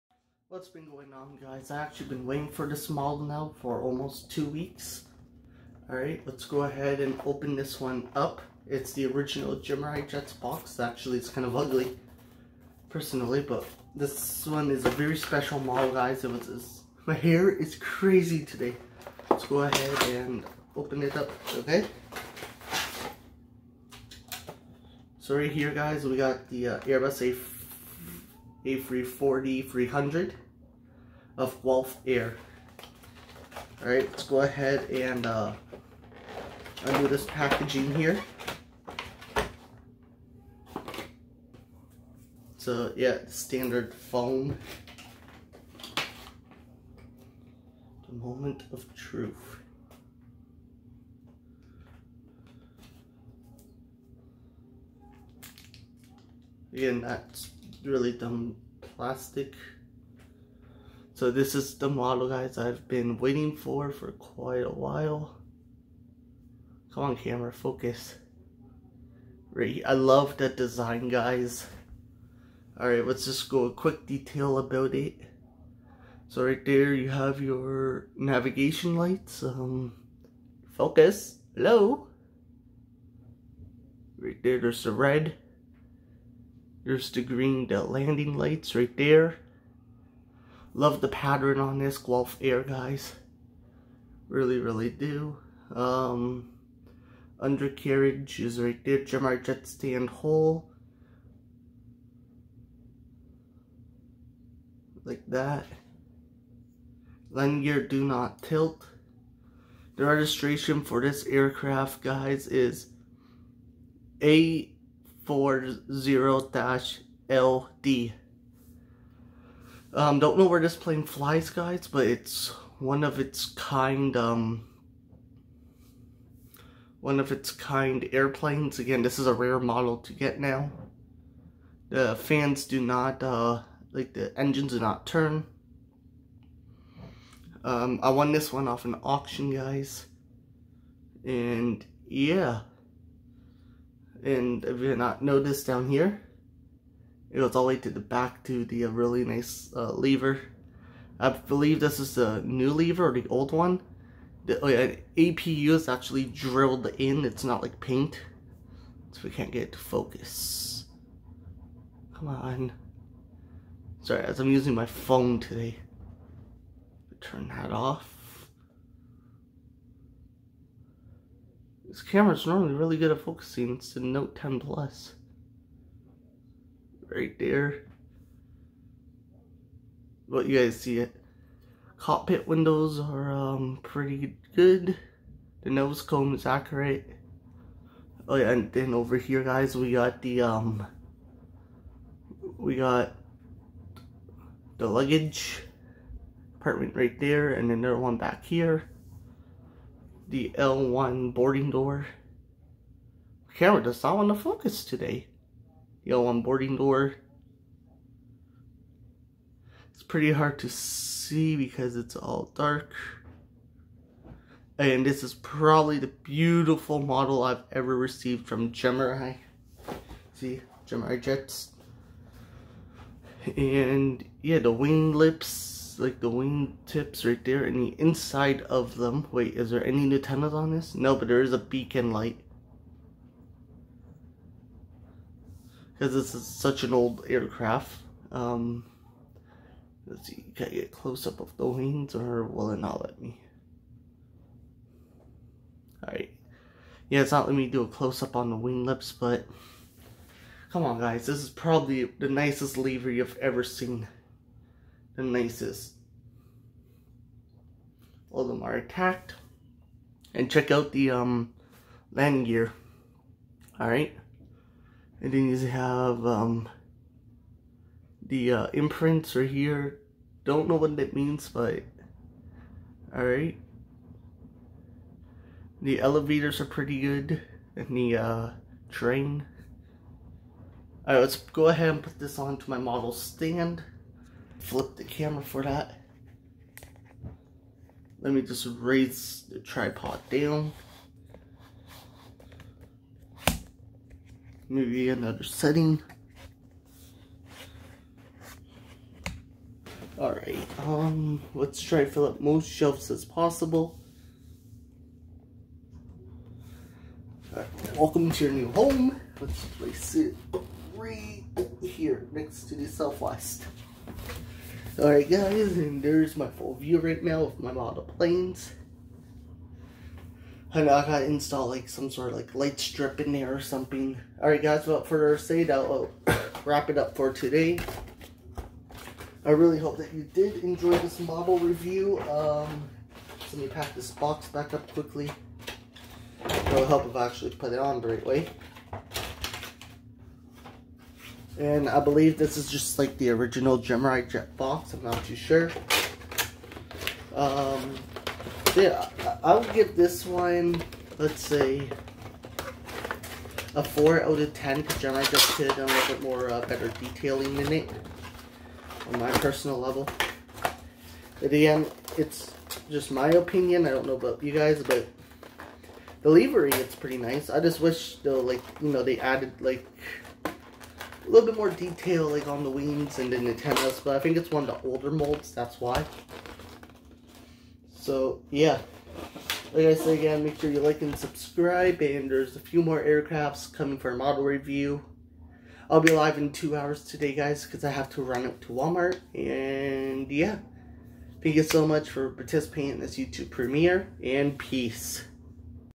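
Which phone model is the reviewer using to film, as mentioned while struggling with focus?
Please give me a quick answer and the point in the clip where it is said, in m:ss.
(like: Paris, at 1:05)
Note 10 Plus, at 2:53.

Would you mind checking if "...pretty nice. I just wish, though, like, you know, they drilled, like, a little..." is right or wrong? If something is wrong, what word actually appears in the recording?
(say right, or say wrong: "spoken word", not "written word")
wrong: "added", not "drilled".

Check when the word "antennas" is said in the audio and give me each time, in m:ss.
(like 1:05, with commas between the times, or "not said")
3:50, 6:13.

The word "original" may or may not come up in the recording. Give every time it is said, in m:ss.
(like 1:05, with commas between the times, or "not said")
0:09, 5:43.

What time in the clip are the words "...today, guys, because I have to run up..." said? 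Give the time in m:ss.
6:27.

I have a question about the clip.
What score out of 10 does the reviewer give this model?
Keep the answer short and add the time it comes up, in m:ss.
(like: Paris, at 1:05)
4, at 5:53.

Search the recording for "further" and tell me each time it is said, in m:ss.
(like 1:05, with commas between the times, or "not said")
5:25.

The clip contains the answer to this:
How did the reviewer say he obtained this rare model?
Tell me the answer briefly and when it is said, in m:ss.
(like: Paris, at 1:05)
auction, at 2:19.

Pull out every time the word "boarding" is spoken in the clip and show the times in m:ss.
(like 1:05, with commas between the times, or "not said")
3:21, 3:26.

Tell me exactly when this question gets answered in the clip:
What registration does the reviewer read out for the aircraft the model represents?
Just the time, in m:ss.
1:54.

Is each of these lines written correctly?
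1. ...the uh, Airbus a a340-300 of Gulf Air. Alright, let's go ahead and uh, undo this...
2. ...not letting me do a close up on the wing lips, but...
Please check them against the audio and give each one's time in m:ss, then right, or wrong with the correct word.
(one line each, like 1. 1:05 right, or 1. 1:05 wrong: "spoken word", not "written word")
1. 0:26 right
2. 4:07 right.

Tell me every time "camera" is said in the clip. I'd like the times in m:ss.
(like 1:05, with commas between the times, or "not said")
1:07, 2:52, 3:23, 4:45.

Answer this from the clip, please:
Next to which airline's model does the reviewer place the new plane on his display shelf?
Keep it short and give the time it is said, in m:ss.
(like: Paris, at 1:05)
Southwest, at 5:12.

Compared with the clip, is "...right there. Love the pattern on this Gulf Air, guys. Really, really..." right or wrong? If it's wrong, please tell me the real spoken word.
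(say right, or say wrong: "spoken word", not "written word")
right.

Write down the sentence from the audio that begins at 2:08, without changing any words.
Again, this is a rare model to get now.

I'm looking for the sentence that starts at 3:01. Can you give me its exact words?
Cockpit windows are um, pretty good.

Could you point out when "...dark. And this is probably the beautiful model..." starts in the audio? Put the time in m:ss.
3:32.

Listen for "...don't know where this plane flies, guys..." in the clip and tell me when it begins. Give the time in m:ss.
2:00.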